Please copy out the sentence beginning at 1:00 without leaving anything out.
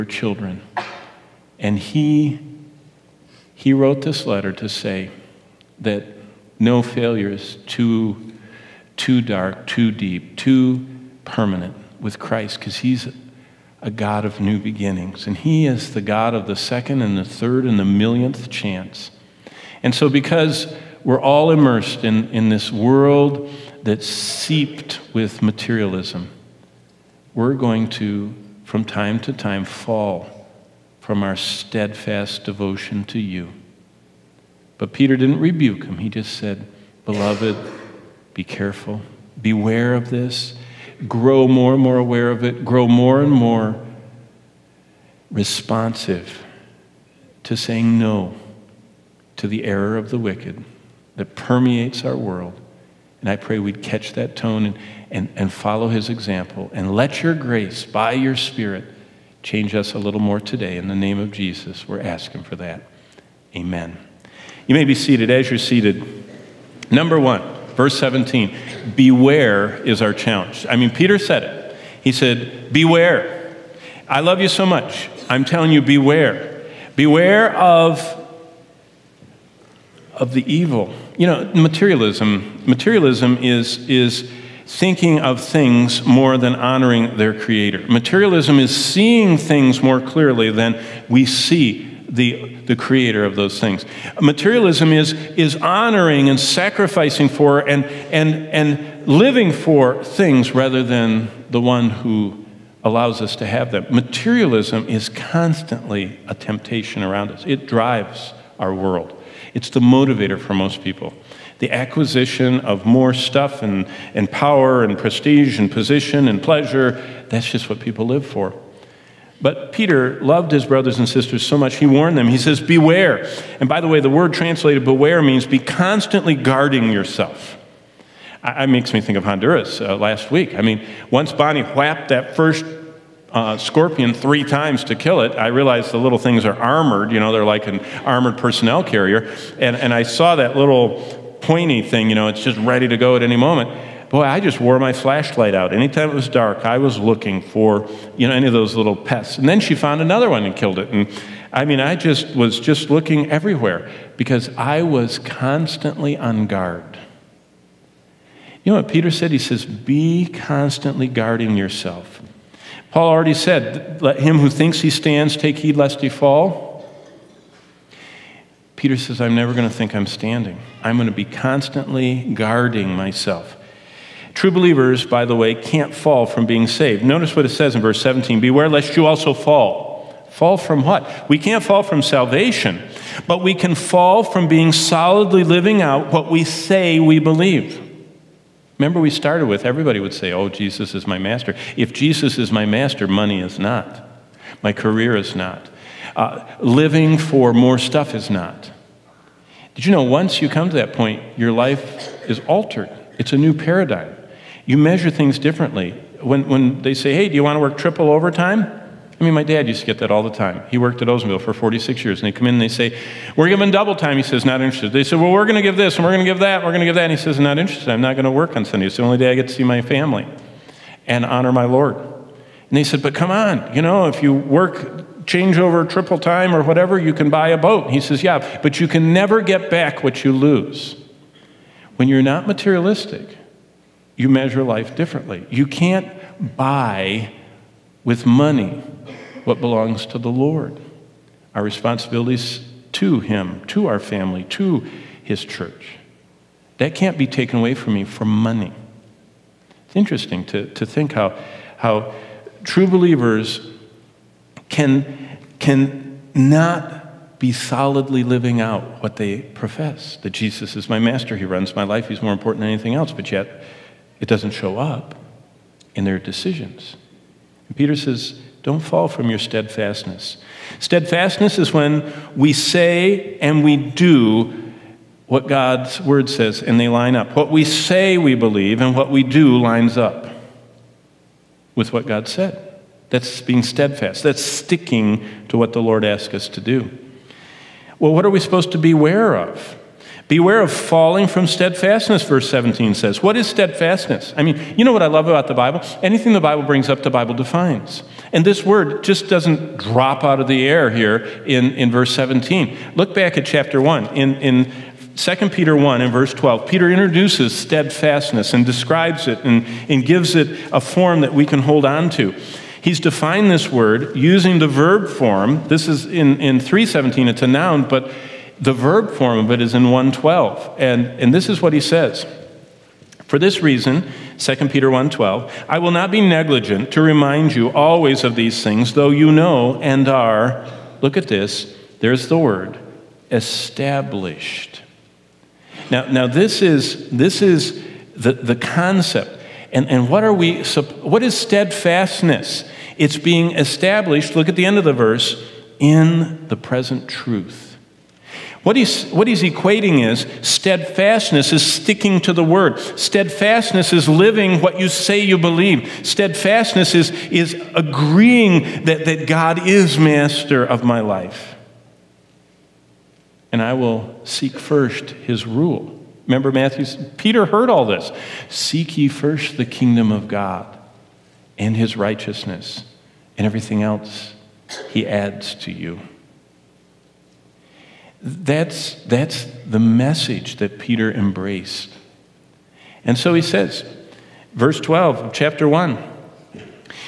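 In the name of Jesus, we're asking for that.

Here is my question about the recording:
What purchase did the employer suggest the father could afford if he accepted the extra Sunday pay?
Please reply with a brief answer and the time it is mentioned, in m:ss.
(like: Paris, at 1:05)
a boat, at 3:47.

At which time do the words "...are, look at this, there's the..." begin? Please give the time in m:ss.
5:30.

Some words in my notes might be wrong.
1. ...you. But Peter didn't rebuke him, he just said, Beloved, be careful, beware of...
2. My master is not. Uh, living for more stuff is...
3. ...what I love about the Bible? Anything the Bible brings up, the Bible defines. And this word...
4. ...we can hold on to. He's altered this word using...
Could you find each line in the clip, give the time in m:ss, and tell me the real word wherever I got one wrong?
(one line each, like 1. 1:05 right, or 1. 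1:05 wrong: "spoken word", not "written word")
1. 0:33 right
2. 3:14 wrong: "career", not "master"
3. 4:54 right
4. 5:11 wrong: "defined", not "altered".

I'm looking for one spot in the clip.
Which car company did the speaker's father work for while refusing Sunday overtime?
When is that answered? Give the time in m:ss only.
3:31.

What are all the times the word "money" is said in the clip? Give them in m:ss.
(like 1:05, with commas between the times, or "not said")
3:13, 3:58, 4:08.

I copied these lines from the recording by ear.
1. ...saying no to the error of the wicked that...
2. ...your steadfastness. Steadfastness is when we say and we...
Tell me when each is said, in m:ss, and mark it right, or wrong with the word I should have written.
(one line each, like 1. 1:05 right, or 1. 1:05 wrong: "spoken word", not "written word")
1. 0:47 right
2. 4:29 right.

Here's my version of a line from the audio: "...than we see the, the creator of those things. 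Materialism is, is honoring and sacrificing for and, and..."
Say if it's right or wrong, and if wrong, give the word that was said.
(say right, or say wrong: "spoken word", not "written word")
right.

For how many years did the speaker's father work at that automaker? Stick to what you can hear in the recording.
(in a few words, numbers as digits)
46.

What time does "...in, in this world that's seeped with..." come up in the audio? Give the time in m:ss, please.
0:22.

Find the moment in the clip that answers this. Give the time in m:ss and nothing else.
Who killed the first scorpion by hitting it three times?
2:11.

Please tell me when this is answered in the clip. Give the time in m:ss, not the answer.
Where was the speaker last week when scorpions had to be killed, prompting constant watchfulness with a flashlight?
2:09.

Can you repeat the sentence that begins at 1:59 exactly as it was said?
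But Peter loved his brothers and sisters so much, he warned them.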